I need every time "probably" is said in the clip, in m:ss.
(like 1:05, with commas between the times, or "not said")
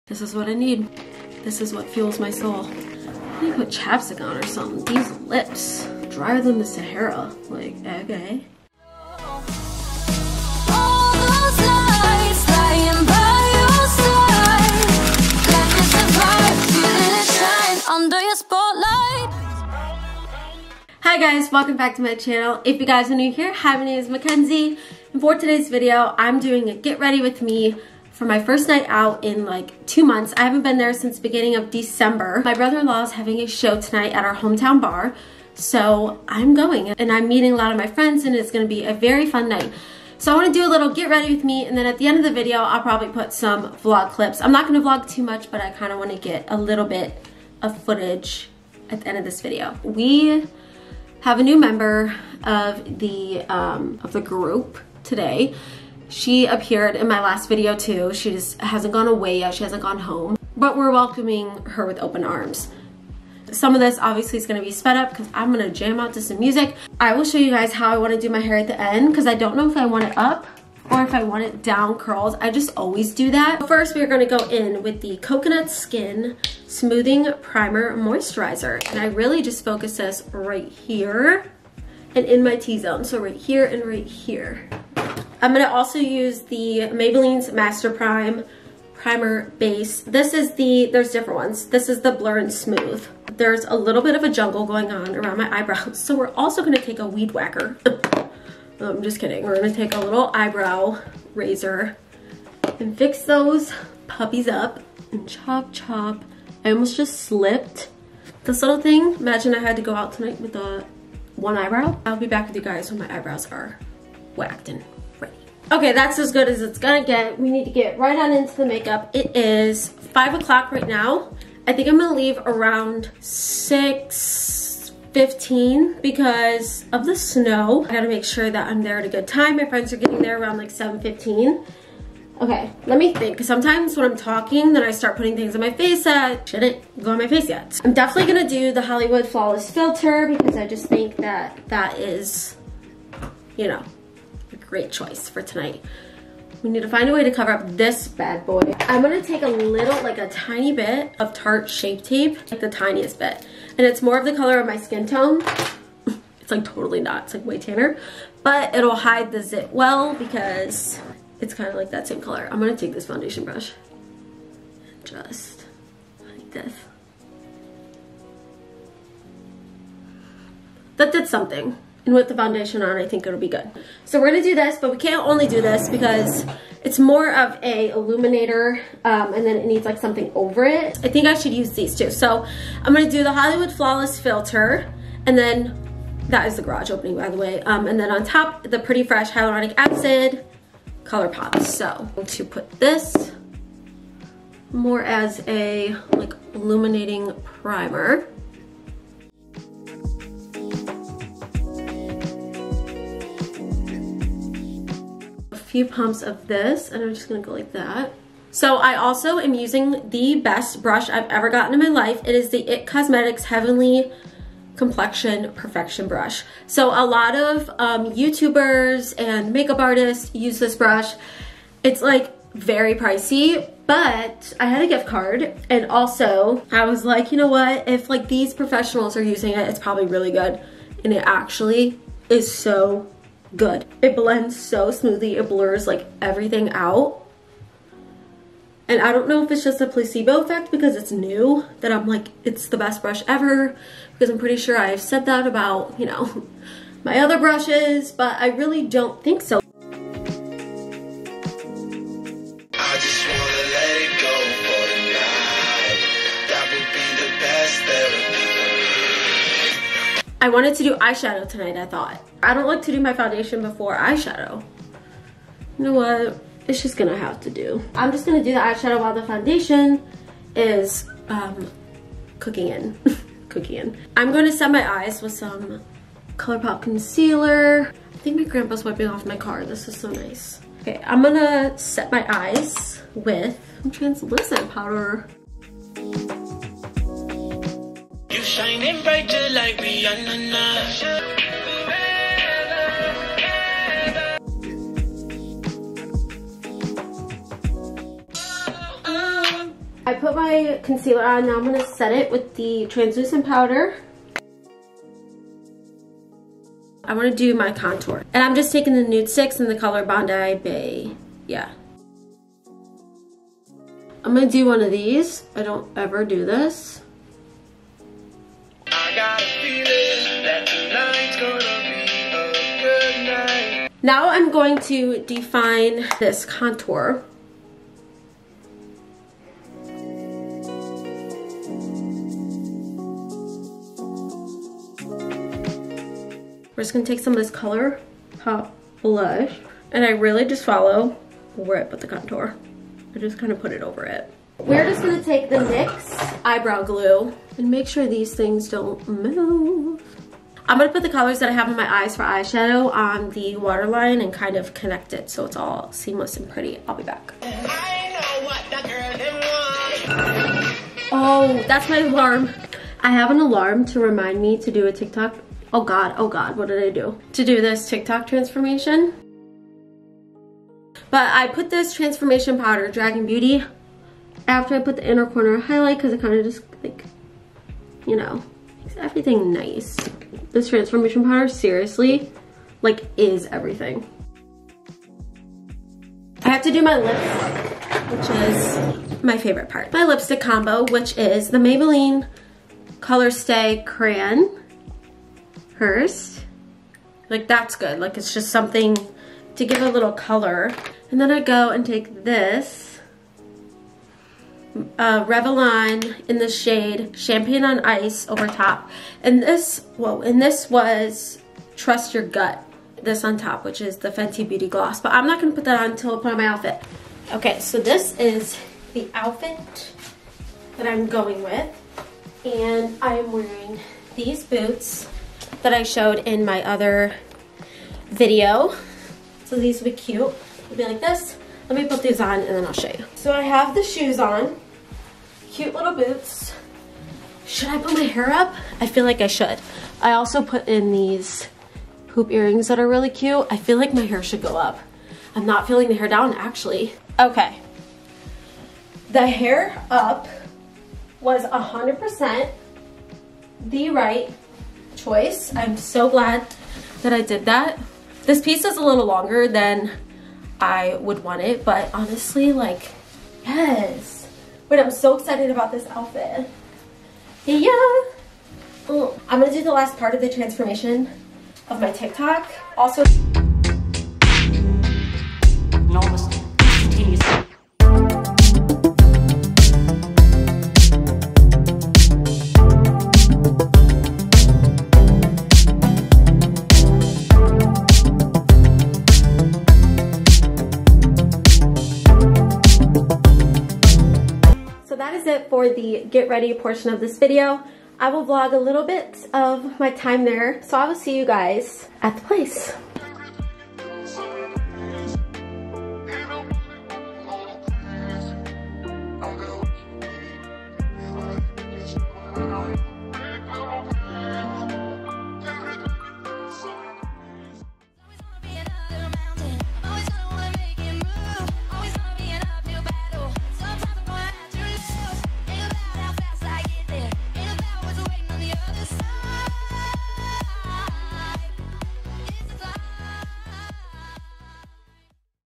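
0:42, 3:49.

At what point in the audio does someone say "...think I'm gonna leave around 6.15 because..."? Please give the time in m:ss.
2:01.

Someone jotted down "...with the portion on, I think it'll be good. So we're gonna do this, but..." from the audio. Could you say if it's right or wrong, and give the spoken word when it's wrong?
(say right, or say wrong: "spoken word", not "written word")
wrong: "foundation", not "portion".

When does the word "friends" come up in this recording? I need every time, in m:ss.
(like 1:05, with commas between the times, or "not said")
0:37, 2:09.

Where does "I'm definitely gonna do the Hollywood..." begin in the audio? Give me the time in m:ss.
2:17.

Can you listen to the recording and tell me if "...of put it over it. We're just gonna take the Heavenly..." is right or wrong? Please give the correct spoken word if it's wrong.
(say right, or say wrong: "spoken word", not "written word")
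wrong: "NYX", not "Heavenly".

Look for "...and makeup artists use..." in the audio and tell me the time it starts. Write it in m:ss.
3:39.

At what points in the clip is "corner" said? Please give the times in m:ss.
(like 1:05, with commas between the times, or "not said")
6:15.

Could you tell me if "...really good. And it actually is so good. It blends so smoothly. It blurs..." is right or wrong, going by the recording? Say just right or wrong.
right.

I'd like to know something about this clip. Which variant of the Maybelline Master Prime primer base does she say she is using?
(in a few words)
Blur and Smooth.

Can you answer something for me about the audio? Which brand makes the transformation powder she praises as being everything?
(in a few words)
Dragun Beauty.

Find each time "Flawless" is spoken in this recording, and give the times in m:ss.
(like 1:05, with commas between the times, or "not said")
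2:19, 3:03.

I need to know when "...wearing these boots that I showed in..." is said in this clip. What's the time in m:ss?
7:03.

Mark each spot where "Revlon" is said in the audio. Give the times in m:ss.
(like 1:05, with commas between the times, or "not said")
6:45.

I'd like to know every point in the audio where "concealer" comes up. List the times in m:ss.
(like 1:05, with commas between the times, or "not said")
4:36, 5:00.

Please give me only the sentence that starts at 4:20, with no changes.
I wanted to do eyeshadow tonight, I thought.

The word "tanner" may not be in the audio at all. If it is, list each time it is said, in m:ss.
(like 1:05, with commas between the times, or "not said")
2:37.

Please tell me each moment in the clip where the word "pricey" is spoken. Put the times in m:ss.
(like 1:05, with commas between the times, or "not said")
3:42.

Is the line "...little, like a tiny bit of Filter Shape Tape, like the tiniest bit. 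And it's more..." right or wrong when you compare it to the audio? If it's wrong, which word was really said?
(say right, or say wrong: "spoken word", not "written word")
wrong: "Tarte", not "Filter".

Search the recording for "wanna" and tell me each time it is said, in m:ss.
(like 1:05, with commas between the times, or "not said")
0:40, 0:45, 1:07, 5:07.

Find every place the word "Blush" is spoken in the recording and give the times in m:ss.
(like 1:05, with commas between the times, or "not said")
5:39.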